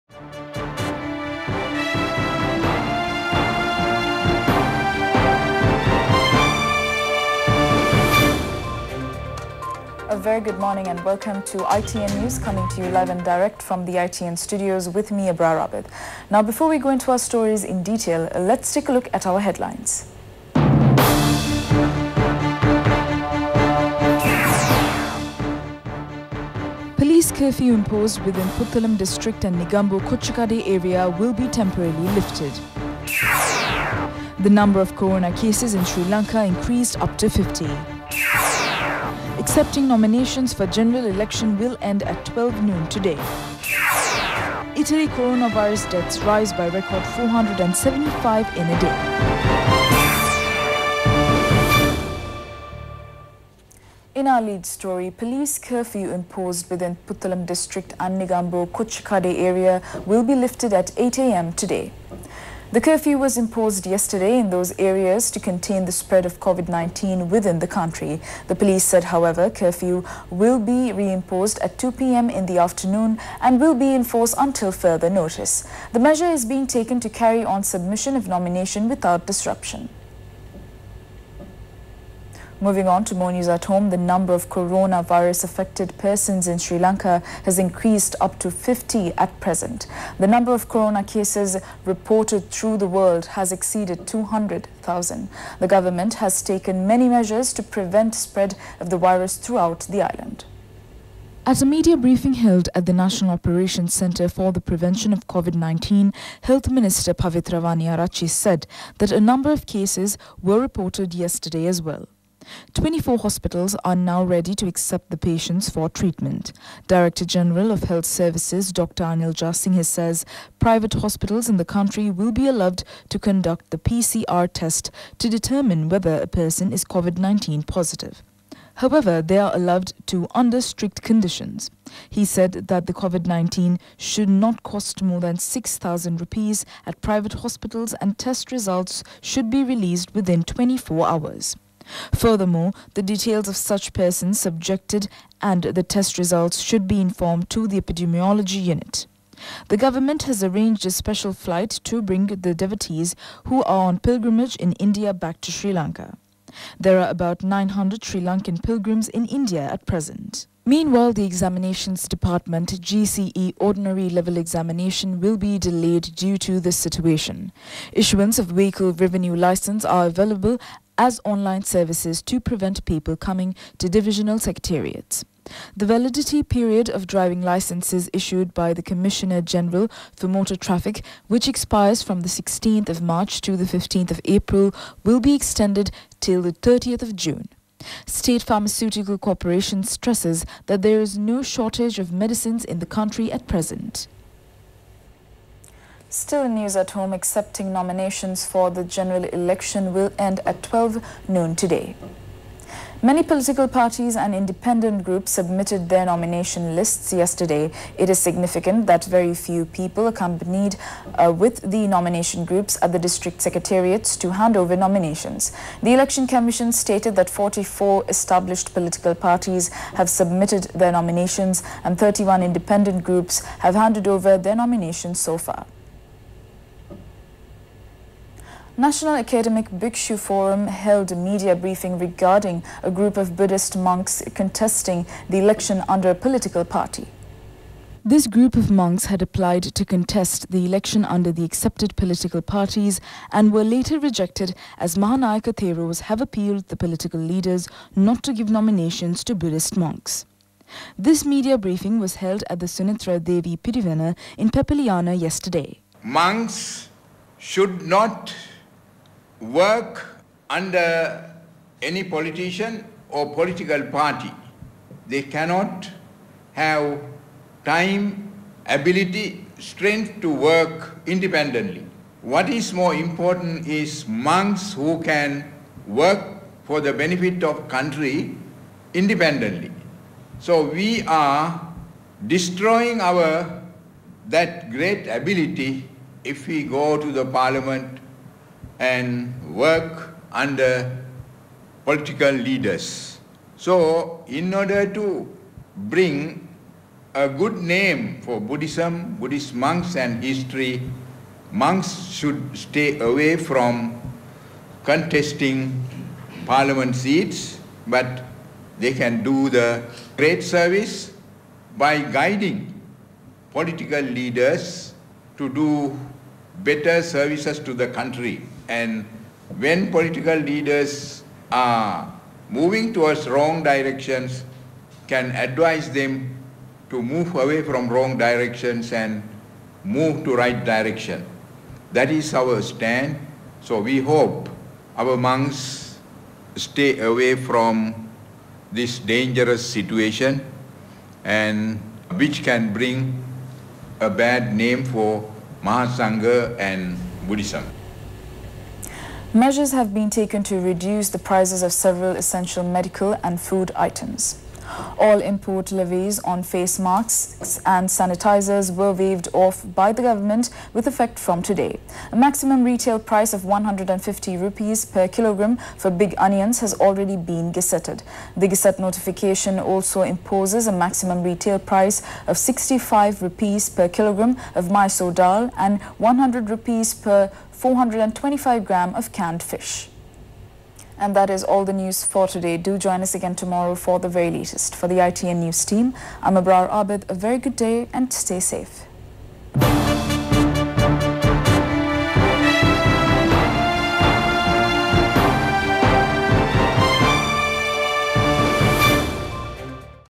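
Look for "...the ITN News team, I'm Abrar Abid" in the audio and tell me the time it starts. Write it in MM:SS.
06:24.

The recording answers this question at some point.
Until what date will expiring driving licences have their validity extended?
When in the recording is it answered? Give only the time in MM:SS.
03:06.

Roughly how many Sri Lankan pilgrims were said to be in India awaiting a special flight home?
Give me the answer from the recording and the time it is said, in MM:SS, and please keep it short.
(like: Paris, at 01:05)
900, at 02:37.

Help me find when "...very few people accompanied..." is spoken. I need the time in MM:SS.
03:29.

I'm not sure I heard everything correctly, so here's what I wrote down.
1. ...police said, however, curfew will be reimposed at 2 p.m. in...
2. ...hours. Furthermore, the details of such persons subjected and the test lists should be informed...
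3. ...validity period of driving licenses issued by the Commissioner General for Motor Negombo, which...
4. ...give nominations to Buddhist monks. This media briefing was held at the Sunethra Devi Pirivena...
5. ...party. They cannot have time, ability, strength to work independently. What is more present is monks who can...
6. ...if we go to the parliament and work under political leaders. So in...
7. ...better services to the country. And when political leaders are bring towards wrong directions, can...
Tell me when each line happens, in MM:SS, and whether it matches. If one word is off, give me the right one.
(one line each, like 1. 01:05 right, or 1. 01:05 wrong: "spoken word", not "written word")
1. 01:08 right
2. 02:21 wrong: "results", not "lists"
3. 02:55 wrong: "Traffic", not "Negombo"
4. 04:08 right
5. 04:23 wrong: "important", not "present"
6. 04:46 right
7. 05:16 wrong: "moving", not "bring".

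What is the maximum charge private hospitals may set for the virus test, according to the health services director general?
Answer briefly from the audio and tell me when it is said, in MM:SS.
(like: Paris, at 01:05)
6,000 rupees, at 02:15.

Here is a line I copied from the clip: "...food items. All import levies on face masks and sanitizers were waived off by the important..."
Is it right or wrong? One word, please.
wrong.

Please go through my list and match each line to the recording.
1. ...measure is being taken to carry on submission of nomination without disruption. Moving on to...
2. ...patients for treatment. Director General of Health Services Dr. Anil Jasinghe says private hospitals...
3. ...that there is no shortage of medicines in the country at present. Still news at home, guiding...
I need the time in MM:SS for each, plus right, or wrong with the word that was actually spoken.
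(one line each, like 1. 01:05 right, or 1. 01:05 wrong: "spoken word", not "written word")
1. 01:15 right
2. 01:55 right
3. 03:10 wrong: "accepting", not "guiding".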